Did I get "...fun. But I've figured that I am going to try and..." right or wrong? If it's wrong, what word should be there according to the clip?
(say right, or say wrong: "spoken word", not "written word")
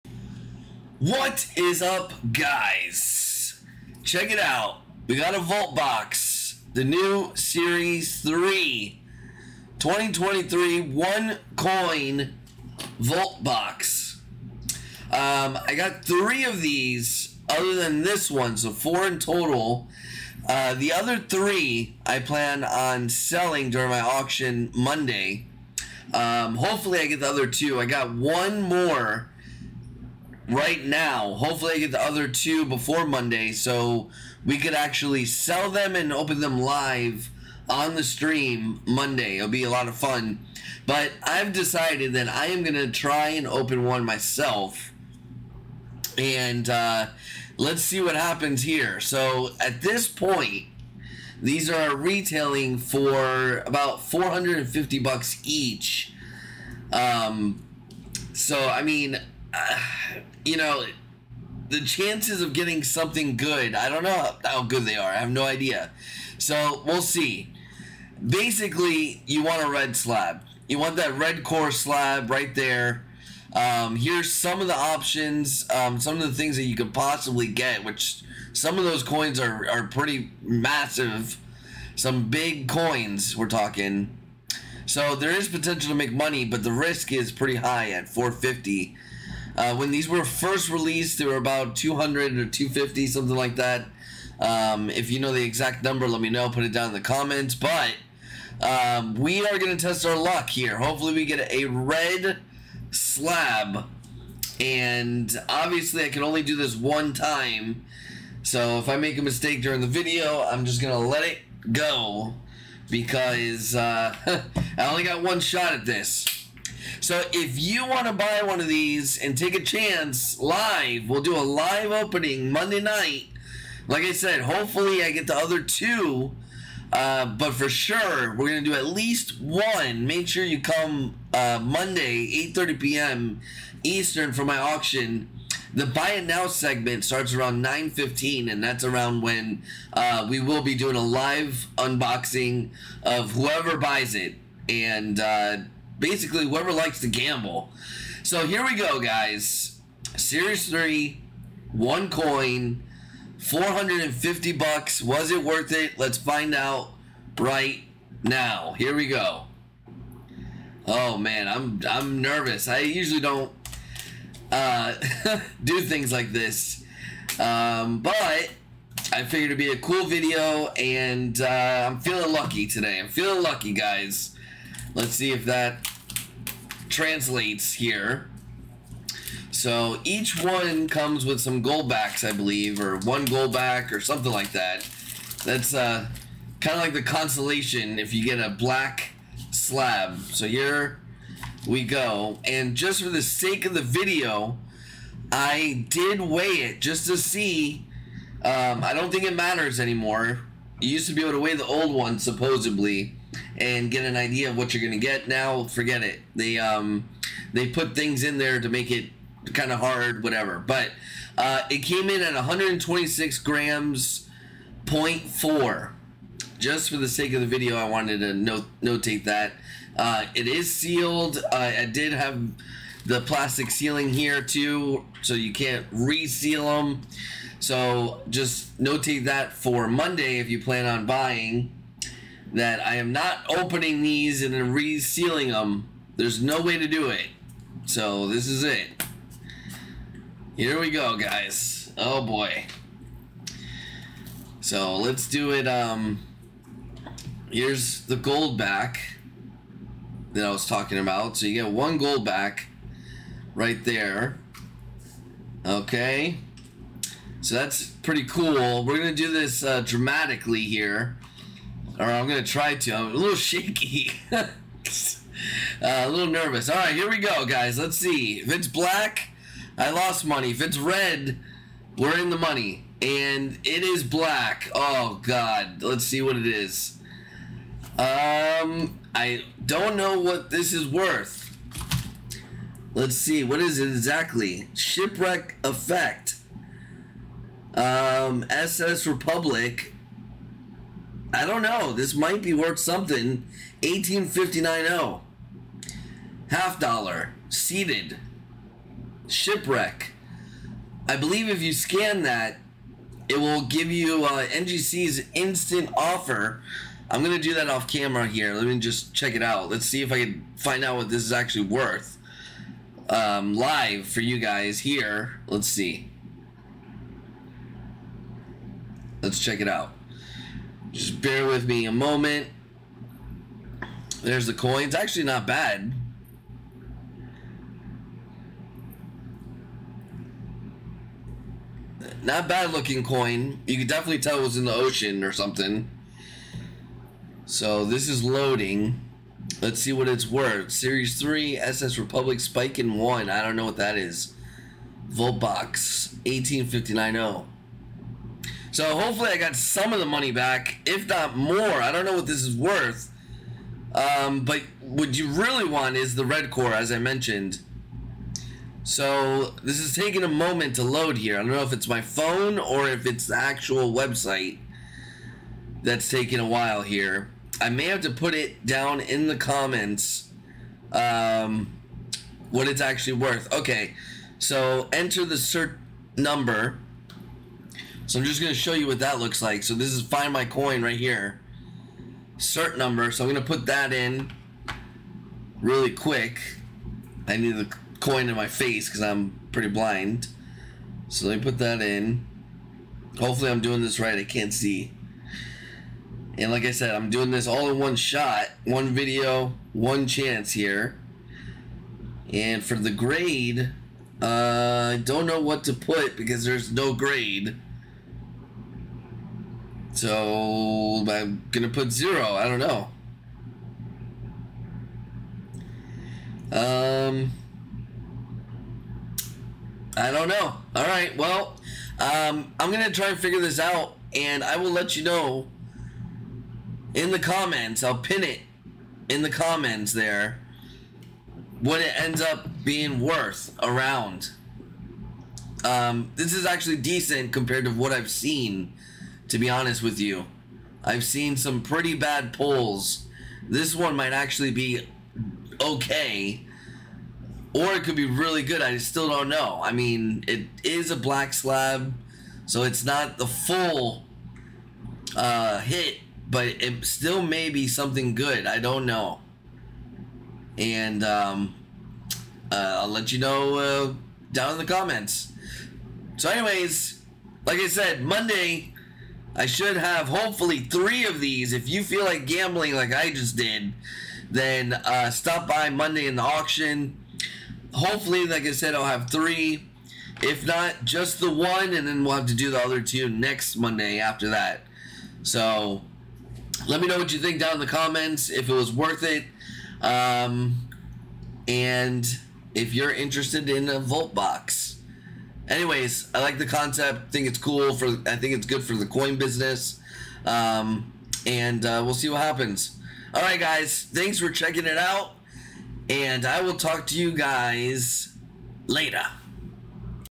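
wrong: "decided", not "figured".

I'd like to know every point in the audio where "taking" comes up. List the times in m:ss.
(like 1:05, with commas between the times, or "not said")
5:59, 6:06.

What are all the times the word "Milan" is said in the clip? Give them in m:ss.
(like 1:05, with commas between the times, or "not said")
not said.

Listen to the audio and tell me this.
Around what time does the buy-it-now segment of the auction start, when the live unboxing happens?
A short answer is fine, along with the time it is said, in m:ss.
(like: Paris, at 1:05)
9:15, at 2:17.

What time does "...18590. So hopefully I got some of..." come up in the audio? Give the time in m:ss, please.
5:46.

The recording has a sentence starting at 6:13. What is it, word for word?
Okay, so enter the cert number so I'm just going to show you what that looks like.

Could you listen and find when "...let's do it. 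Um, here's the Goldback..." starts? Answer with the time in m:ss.
4:04.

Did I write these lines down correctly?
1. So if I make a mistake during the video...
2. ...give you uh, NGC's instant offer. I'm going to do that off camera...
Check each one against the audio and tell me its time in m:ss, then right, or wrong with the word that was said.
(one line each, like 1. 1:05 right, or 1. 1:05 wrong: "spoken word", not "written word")
1. 1:48 right
2. 5:03 right.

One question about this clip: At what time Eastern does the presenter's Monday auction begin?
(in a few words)
8:30 p.m.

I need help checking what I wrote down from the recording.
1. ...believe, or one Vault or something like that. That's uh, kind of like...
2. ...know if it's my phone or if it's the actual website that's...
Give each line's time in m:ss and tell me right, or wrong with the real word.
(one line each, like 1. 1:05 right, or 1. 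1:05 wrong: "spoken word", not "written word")
1. 3:02 wrong: "Goldback", not "Vault"
2. 6:01 right.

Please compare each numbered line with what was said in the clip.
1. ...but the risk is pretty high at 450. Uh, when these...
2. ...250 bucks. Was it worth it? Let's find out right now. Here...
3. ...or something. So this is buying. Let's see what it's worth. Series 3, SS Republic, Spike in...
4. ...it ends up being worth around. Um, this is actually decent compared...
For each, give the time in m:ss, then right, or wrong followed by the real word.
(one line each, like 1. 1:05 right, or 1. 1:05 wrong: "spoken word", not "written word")
1. 1:26 right
2. 2:33 wrong: "450", not "250"
3. 5:35 wrong: "loading", not "buying"
4. 7:11 right.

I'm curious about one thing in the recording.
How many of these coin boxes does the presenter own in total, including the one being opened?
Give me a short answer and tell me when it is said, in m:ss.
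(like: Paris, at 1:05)
4, at 0:18.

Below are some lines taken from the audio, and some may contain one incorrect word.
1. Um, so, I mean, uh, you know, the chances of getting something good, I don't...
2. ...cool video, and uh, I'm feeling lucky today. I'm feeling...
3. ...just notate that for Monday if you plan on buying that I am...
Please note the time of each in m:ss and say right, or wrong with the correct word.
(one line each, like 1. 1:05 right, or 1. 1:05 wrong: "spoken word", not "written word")
1. 0:56 right
2. 2:49 right
3. 3:48 right.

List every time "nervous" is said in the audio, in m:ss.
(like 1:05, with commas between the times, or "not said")
2:42, 4:26.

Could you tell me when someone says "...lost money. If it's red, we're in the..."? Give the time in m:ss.
4:29.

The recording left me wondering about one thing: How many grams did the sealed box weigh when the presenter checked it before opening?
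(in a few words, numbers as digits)
126.4 grams.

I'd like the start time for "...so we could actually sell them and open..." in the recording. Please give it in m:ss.
0:33.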